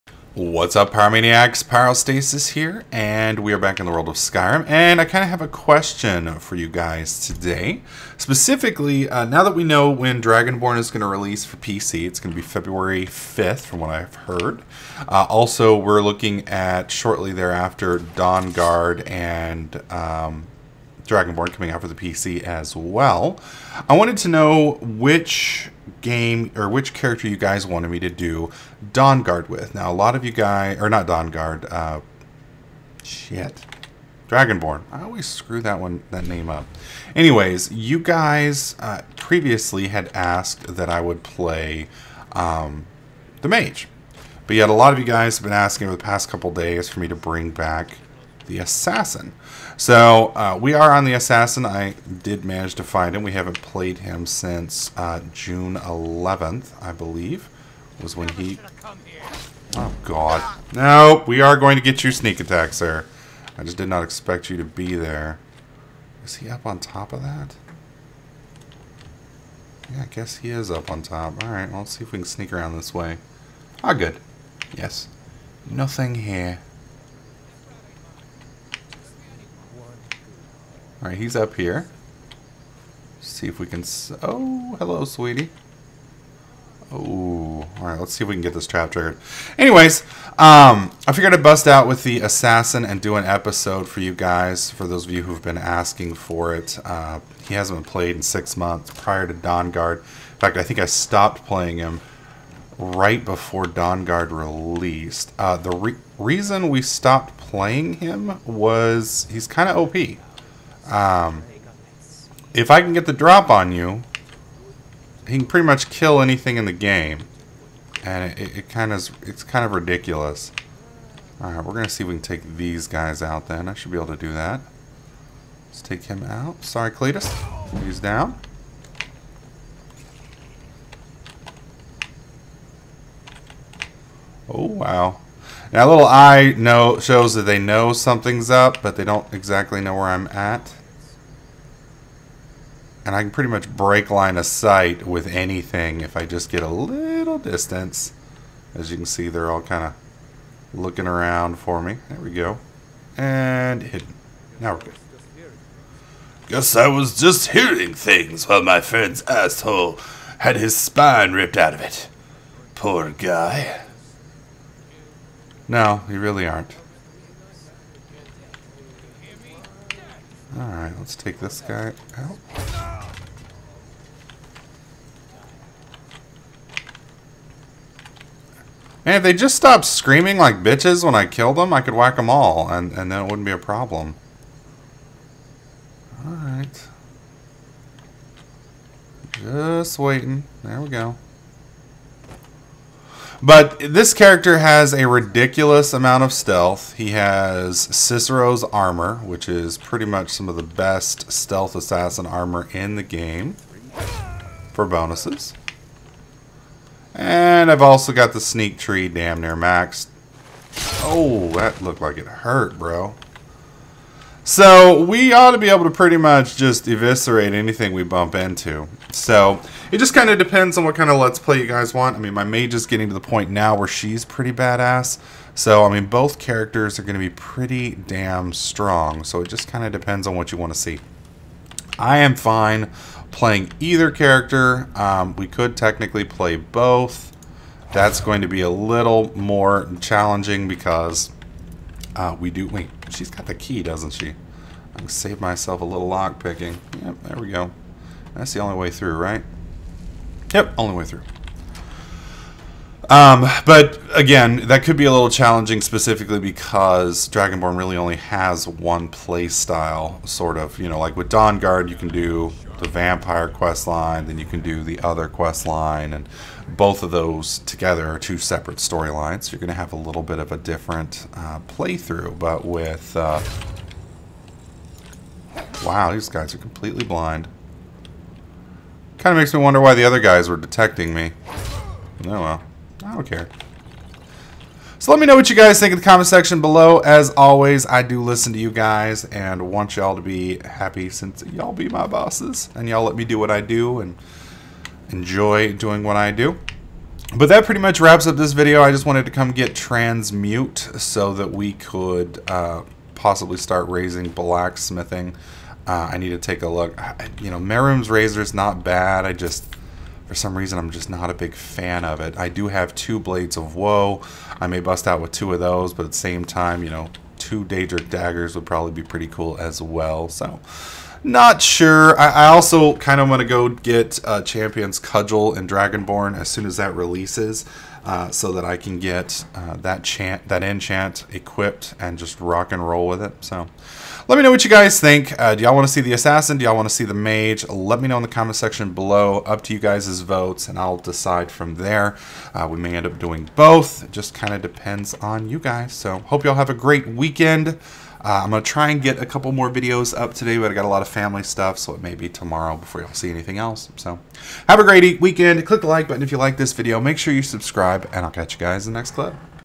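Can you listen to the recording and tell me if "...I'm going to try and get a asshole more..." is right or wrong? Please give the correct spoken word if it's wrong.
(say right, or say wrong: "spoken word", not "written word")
wrong: "couple", not "asshole".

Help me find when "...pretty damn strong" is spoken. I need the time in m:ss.
3:47.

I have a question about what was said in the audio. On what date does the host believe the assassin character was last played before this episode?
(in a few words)
June 11th.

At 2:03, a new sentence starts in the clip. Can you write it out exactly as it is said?
I should be able to do that.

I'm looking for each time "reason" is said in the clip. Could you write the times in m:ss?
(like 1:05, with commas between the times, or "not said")
1:46, 5:10.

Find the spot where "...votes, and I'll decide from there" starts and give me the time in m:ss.
5:40.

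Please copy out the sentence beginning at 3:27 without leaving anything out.
And I've also got the sneak tree damn near maxed.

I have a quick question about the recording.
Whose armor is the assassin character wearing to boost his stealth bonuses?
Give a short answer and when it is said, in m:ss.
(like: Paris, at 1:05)
Cicero's, at 3:17.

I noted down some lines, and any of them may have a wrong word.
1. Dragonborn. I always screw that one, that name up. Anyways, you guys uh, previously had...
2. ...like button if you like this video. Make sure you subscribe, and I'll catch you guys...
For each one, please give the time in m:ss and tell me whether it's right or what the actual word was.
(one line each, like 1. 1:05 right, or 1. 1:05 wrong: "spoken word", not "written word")
1. 0:34 right
2. 5:55 right.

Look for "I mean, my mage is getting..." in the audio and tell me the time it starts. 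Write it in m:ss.
3:42.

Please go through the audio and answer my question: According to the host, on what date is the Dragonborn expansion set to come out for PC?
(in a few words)
February 5th.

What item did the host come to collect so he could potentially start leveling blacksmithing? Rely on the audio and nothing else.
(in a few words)
Transmute.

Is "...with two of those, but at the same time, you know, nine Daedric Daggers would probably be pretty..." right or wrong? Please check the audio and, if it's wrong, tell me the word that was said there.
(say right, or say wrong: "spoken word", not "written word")
wrong: "two", not "nine".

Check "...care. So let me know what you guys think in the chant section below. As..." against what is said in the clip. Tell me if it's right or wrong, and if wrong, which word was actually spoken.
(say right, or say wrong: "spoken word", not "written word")
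wrong: "comment", not "chant".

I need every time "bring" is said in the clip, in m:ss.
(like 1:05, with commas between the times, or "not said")
0:47.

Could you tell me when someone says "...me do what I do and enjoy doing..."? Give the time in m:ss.
4:53.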